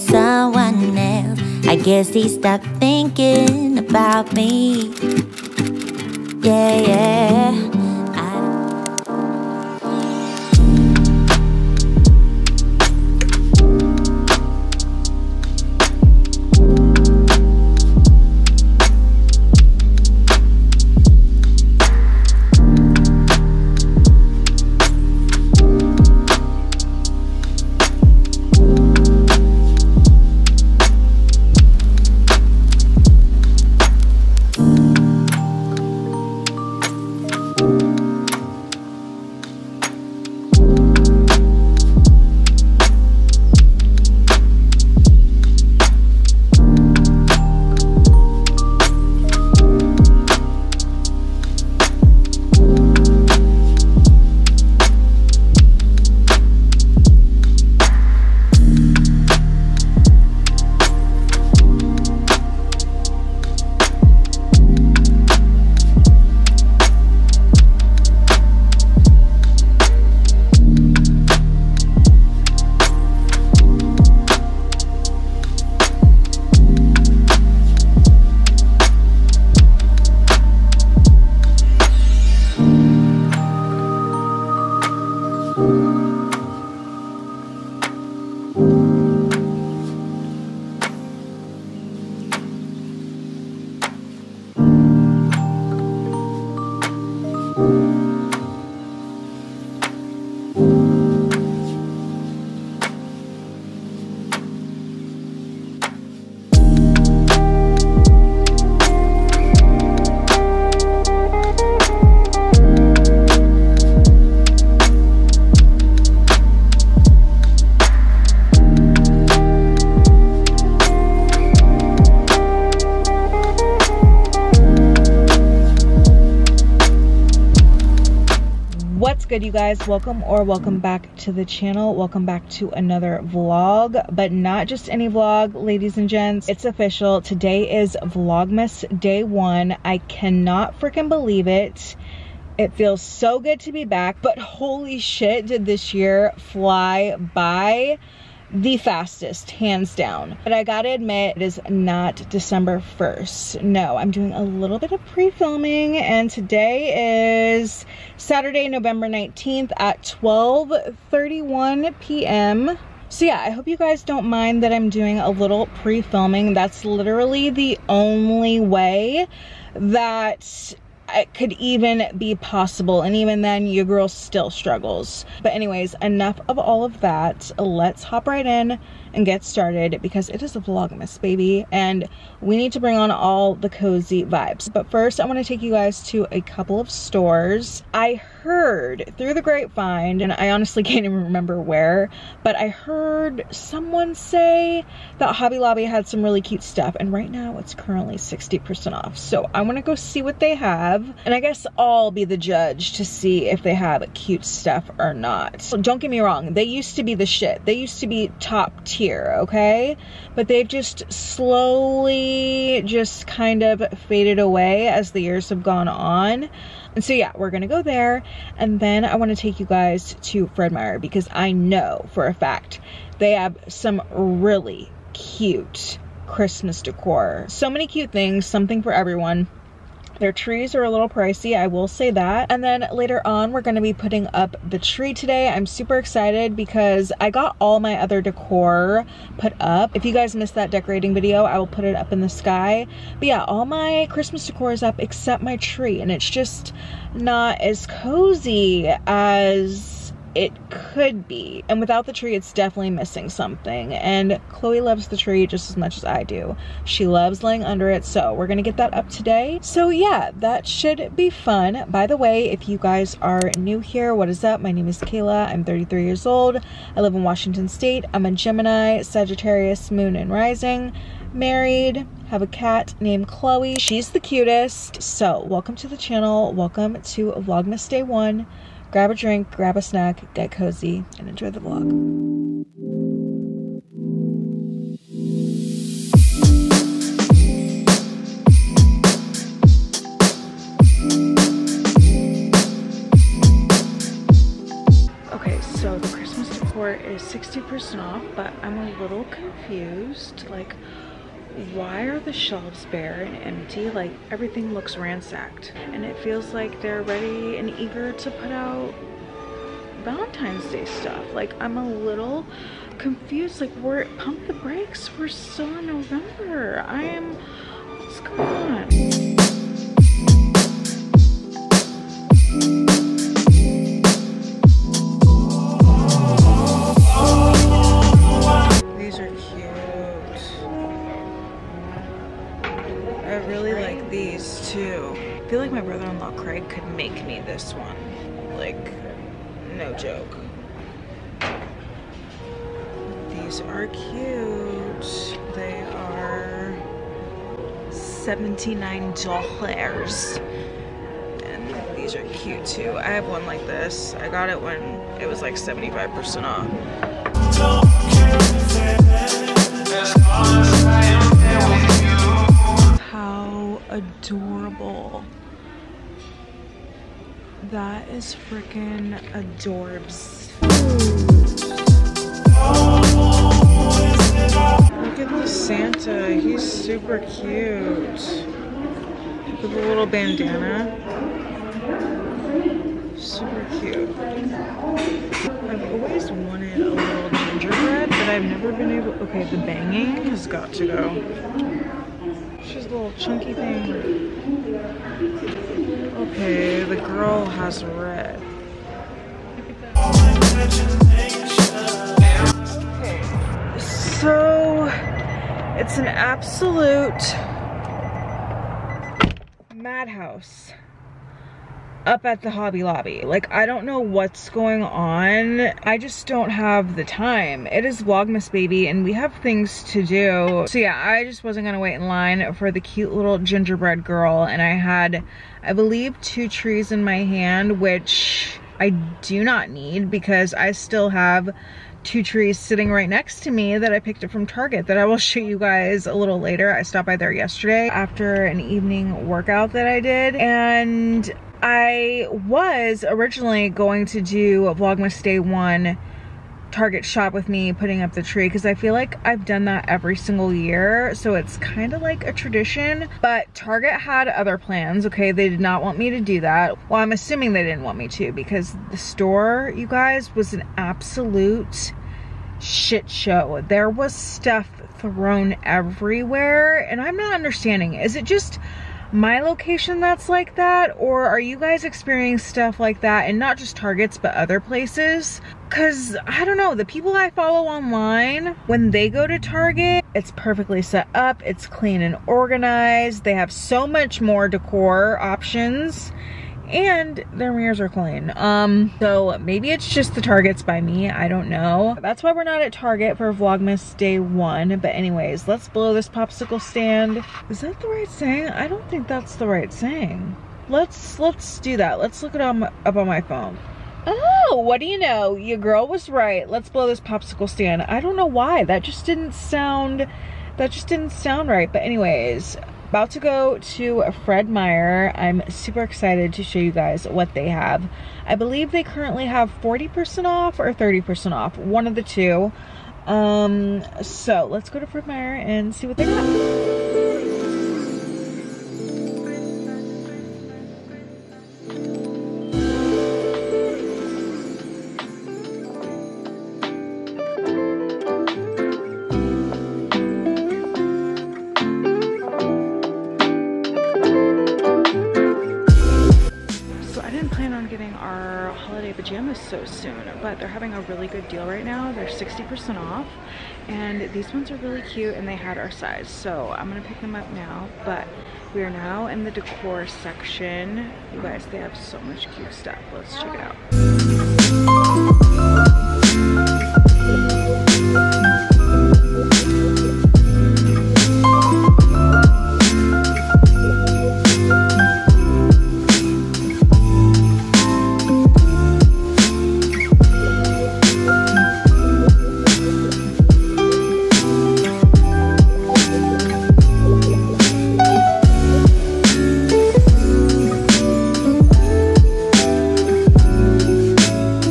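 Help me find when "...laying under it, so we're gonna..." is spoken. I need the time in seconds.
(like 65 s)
257 s.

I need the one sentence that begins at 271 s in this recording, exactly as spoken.
Married, have a cat named Chloe.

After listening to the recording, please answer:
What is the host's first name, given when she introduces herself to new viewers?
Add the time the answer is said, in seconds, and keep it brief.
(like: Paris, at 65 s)
Kayla, at 265 s.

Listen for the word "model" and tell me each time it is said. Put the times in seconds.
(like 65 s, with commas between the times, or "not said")
not said.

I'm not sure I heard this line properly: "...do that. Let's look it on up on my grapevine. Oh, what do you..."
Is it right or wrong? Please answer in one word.
wrong.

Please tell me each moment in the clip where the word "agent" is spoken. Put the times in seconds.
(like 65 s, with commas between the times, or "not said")
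not said.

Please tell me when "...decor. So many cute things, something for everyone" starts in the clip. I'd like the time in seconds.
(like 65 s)
226 s.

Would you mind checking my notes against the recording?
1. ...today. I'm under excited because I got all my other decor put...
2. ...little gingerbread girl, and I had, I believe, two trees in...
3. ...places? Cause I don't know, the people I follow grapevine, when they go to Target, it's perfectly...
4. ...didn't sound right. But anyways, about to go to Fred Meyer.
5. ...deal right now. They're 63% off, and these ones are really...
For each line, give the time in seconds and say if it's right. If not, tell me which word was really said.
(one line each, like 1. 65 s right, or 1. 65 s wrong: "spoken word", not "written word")
1. 235 s wrong: "super", not "under"
2. 423 s right
3. 474 s wrong: "online", not "grapevine"
4. 510 s right
5. 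551 s wrong: "60", not "63".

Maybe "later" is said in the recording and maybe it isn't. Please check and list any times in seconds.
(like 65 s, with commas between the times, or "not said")
232 s, 436 s.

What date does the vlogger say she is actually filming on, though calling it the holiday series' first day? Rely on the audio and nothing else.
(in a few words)
Saturday, November 19th.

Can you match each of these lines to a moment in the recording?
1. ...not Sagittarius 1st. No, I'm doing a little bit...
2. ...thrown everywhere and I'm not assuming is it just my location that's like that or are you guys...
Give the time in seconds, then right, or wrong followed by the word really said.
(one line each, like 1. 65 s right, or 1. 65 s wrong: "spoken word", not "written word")
1. 151 s wrong: "December", not "Sagittarius"
2. 464 s wrong: "understanding", not "assuming".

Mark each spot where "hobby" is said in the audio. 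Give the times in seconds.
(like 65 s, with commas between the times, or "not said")
195 s, 412 s.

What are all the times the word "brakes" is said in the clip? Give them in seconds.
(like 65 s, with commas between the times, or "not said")
314 s.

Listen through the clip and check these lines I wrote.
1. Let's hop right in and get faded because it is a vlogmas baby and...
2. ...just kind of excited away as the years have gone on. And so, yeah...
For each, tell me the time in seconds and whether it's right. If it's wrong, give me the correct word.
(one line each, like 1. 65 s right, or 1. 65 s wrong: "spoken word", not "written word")
1. 177 s wrong: "started", not "faded"
2. 212 s wrong: "faded", not "excited".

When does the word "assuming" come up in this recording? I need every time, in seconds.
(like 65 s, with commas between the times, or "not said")
457 s.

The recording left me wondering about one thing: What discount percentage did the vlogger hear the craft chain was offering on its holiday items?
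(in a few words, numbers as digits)
60%.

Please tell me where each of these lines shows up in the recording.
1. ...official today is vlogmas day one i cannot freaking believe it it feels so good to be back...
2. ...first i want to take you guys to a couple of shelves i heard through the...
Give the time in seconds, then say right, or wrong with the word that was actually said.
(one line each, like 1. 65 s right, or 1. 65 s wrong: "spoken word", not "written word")
1. 136 s right
2. 184 s wrong: "stores", not "shelves".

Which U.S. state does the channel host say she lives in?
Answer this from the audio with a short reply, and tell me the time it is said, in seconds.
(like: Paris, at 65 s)
Washington State, at 267 s.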